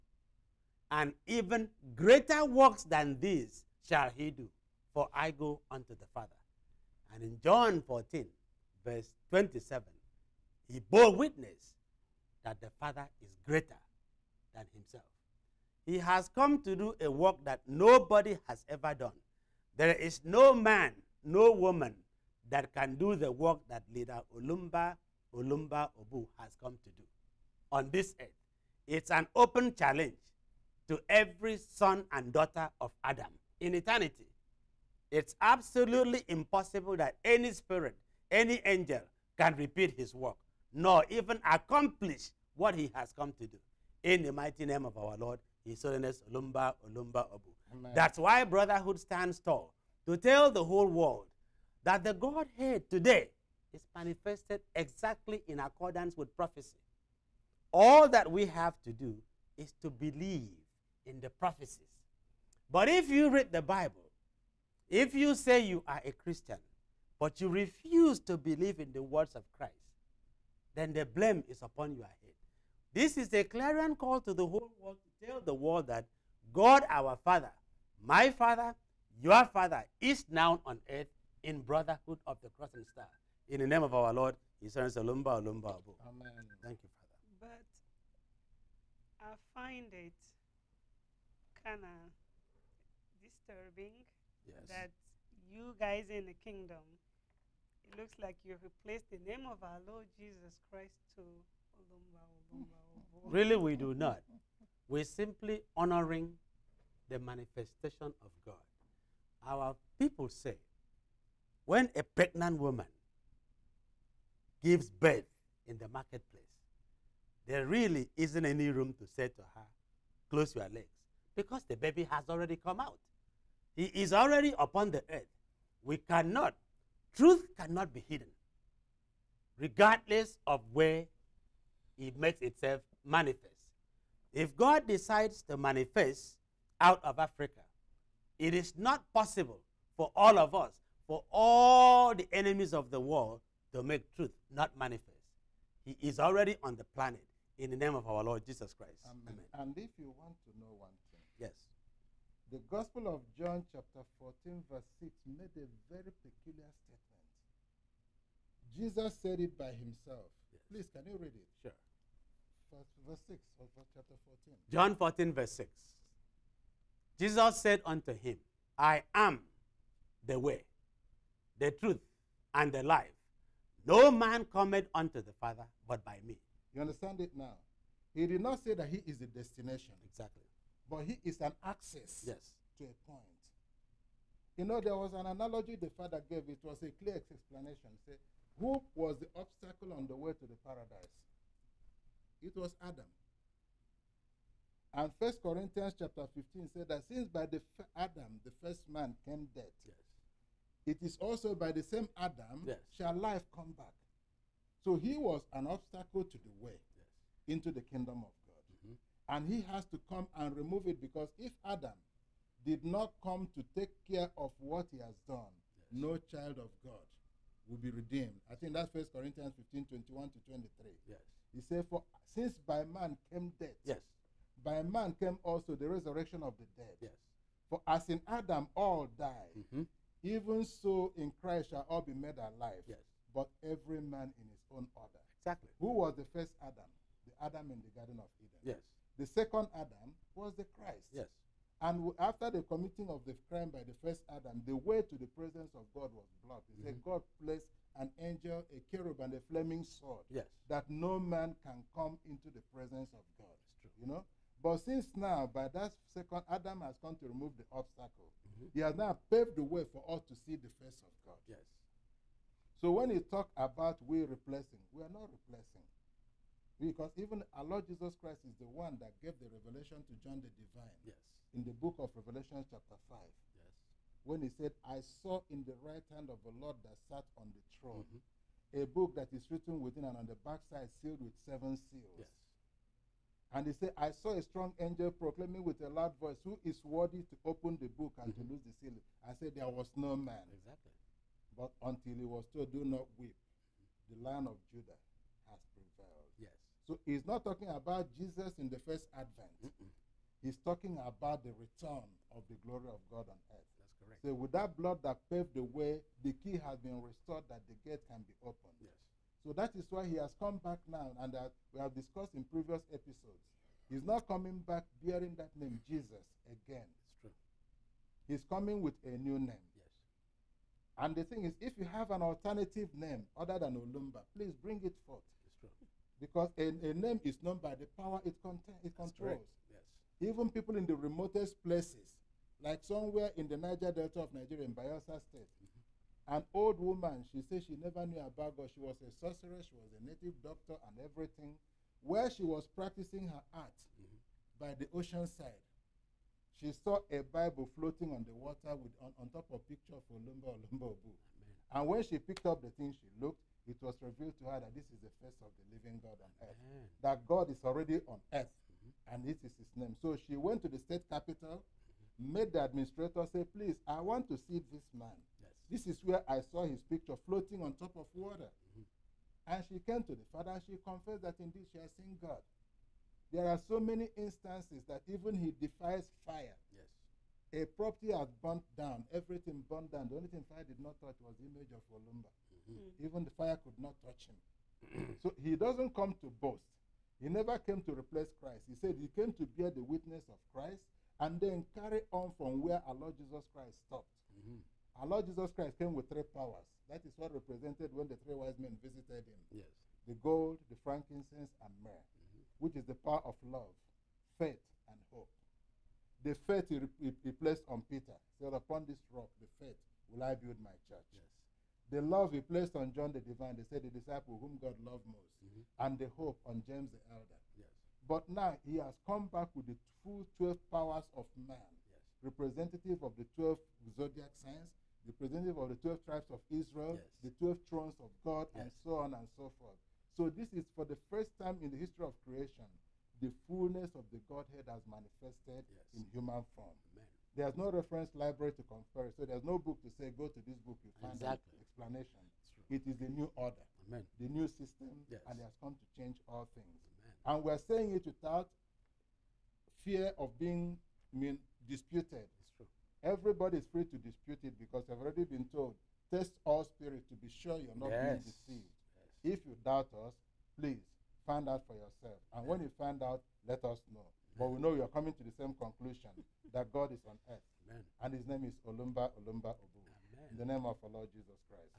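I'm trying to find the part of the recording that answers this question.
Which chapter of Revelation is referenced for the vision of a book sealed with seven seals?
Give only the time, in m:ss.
4:33.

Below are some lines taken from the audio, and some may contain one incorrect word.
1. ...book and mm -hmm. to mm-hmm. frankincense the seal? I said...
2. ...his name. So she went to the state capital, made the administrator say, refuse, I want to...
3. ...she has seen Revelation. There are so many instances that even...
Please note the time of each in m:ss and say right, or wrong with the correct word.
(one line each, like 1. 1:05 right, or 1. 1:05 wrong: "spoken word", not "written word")
1. 4:47 wrong: "loose", not "frankincense"
2. 5:59 wrong: "please", not "refuse"
3. 6:11 wrong: "God", not "Revelation".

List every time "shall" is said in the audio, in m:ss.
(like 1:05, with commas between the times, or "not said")
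0:03, 3:22, 3:51.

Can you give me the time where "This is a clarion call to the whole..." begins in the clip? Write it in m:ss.
1:12.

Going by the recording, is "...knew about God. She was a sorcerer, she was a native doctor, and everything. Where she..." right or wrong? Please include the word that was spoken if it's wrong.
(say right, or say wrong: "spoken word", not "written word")
right.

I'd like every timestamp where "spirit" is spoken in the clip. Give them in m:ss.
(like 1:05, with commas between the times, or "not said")
0:37, 7:36.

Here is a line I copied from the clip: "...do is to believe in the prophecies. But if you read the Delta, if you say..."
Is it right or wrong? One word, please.
wrong.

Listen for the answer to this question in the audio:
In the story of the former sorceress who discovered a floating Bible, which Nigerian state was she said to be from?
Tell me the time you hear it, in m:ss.
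5:34.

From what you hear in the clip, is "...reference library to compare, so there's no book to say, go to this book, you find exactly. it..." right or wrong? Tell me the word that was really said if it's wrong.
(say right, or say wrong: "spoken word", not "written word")
right.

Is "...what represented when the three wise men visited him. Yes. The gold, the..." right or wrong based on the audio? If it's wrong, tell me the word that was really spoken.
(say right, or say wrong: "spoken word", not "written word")
right.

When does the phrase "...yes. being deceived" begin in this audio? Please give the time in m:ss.
7:37.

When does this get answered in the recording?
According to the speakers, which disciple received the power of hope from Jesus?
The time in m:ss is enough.
6:56.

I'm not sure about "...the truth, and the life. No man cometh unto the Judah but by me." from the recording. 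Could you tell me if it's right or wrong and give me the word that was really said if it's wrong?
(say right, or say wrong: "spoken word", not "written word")
wrong: "Father", not "Judah".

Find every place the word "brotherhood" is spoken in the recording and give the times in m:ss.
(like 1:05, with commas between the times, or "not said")
0:48, 1:21.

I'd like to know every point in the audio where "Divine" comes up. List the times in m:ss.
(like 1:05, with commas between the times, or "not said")
4:30, 6:53.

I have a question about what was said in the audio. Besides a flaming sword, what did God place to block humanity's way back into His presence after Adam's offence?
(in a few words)
A cherub.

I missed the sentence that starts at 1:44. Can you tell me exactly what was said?
We're simply honoring the manifestation of God.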